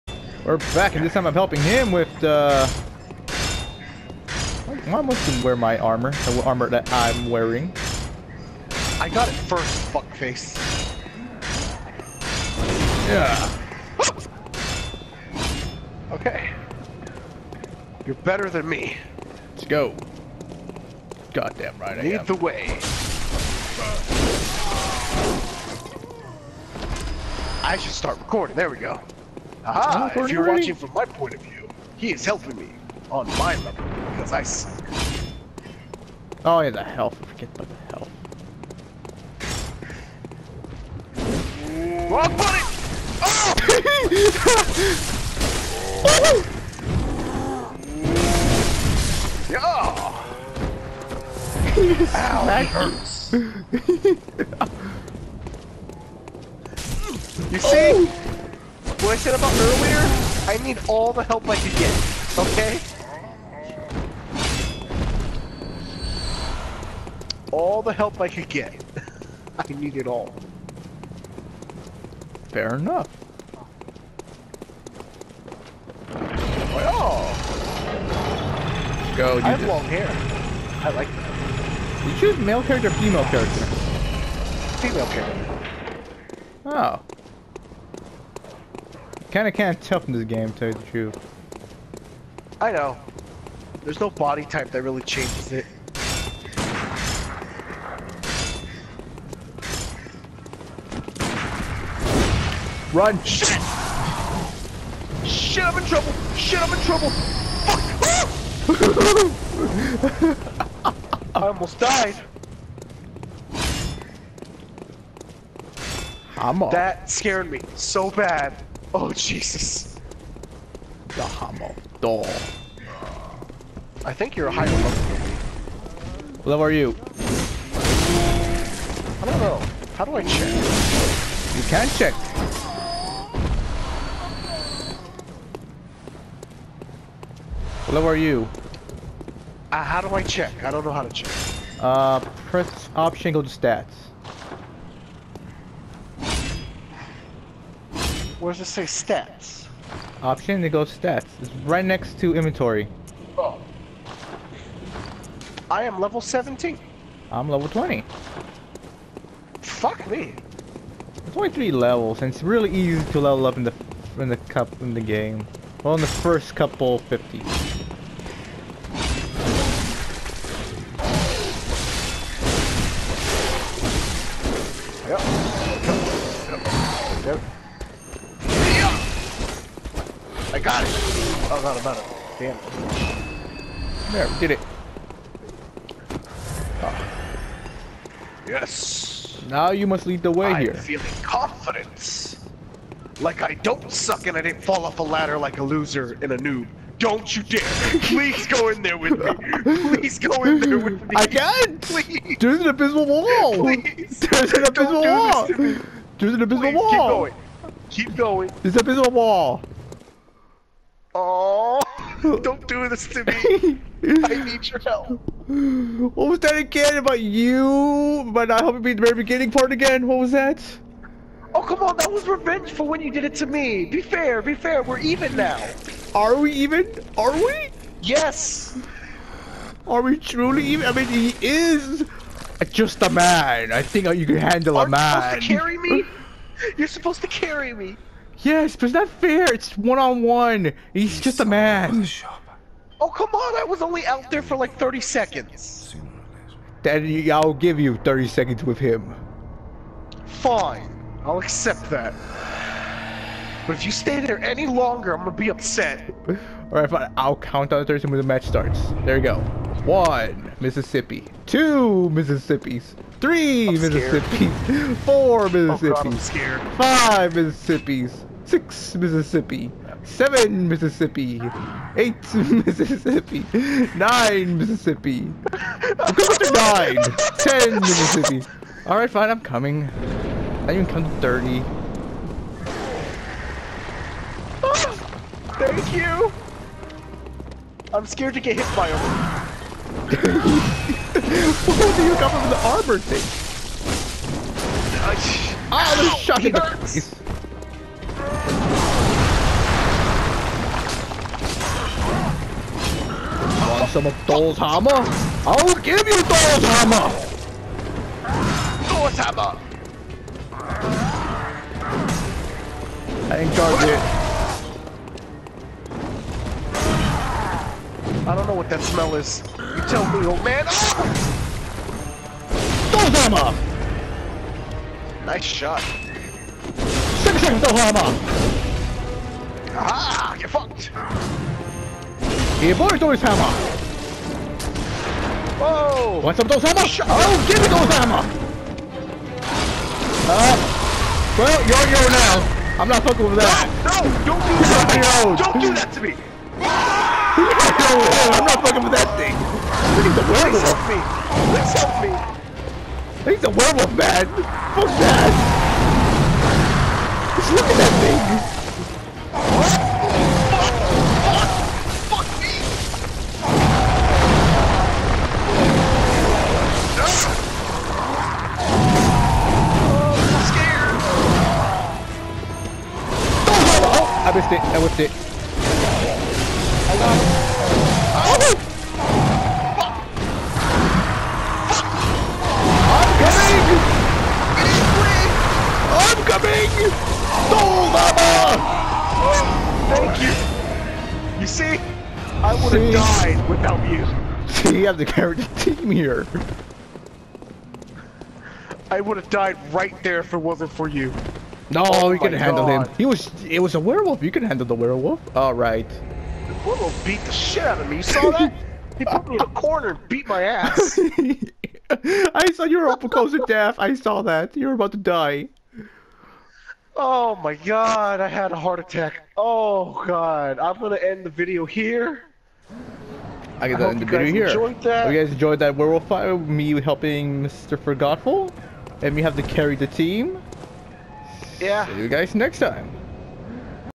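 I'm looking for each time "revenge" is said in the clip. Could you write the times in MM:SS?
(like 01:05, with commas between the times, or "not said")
03:42.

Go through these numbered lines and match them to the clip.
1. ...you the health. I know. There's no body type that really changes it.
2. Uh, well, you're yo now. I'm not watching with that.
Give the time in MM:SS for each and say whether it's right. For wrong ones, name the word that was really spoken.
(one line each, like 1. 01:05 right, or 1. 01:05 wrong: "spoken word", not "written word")
1. 01:30 wrong: "truth", not "health"
2. 05:40 wrong: "fucking", not "watching".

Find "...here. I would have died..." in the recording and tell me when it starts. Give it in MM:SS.
06:35.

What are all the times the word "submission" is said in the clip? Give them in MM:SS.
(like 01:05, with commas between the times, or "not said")
not said.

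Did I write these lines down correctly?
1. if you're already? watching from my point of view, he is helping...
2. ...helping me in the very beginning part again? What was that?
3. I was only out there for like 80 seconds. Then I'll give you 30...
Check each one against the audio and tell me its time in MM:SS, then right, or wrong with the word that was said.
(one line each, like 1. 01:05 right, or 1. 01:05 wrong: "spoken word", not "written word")
1. 00:30 right
2. 03:38 right
3. 04:03 wrong: "30", not "80".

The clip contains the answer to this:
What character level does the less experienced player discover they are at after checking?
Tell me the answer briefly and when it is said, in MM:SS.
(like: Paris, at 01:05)
17, at 02:35.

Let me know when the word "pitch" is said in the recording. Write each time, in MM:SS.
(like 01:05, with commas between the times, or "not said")
not said.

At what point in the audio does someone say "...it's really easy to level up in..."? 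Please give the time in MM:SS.
02:42.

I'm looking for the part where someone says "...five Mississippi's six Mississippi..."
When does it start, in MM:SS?
04:26.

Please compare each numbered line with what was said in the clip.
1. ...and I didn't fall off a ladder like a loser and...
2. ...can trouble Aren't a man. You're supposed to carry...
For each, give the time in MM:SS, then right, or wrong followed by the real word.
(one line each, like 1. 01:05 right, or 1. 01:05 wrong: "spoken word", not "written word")
1. 03:14 right
2. 03:54 wrong: "handle", not "trouble".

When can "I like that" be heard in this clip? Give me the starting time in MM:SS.
01:20.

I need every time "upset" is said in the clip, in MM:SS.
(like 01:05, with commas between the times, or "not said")
04:15.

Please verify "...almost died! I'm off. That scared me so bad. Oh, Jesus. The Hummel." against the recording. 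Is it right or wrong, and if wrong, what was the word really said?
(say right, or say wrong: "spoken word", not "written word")
right.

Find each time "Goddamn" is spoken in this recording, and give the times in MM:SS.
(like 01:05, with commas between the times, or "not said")
00:21.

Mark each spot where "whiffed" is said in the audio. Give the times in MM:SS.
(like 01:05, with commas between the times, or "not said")
06:14.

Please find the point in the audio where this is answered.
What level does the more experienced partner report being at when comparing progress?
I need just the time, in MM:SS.
02:37.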